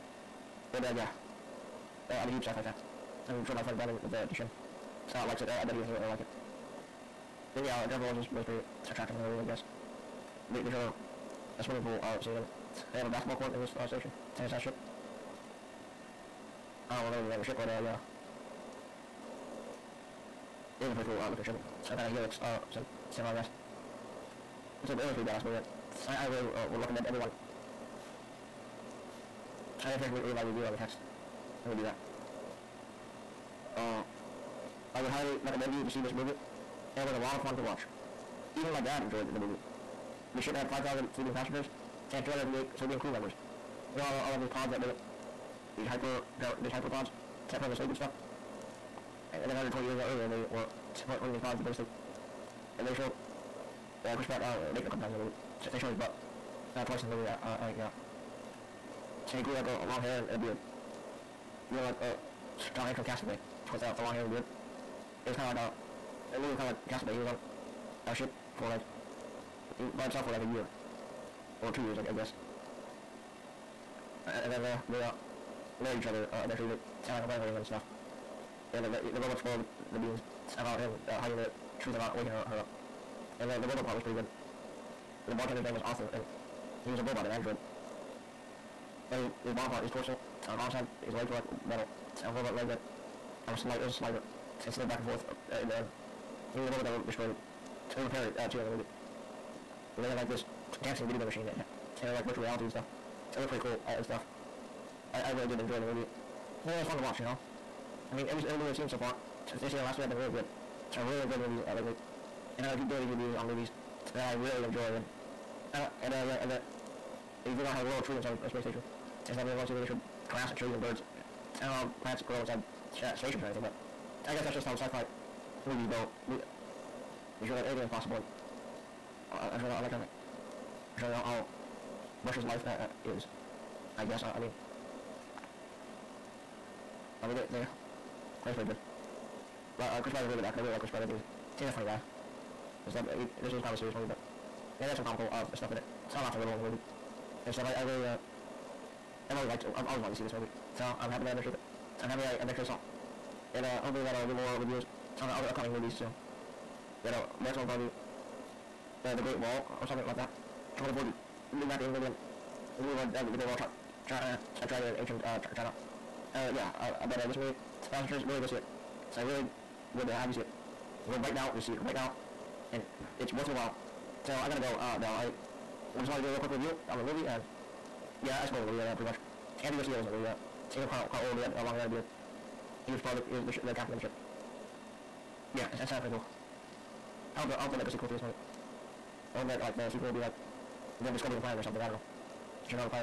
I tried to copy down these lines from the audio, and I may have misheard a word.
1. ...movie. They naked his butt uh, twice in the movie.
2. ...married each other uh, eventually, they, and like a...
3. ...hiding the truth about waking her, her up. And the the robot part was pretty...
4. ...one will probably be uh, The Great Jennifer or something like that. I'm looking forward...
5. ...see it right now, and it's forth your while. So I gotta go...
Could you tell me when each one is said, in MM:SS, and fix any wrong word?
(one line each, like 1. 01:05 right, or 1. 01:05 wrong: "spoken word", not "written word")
1. 00:55 wrong: "showed", not "naked"
2. 01:15 right
3. 01:21 right
4. 02:37 wrong: "Wall", not "Jennifer"
5. 02:51 wrong: "worth", not "forth".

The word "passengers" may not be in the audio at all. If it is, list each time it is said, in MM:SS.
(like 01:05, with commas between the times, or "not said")
00:41, 02:48.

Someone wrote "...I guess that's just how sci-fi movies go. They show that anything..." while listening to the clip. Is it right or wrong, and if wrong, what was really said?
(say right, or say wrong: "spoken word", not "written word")
right.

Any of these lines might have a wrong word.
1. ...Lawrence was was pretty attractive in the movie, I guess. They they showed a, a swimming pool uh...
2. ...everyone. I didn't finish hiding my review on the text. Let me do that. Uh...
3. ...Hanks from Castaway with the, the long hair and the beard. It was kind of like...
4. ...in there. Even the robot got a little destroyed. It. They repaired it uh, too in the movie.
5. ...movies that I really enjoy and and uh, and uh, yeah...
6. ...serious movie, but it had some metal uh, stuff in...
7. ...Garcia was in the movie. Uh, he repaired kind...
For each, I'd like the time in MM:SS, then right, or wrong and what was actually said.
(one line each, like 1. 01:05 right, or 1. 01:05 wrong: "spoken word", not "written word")
1. 00:08 right
2. 00:27 wrong: "reading", not "hiding"
3. 01:02 right
4. 01:35 right
5. 01:53 right
6. 02:23 wrong: "comical", not "metal"
7. 02:59 wrong: "looked", not "repaired".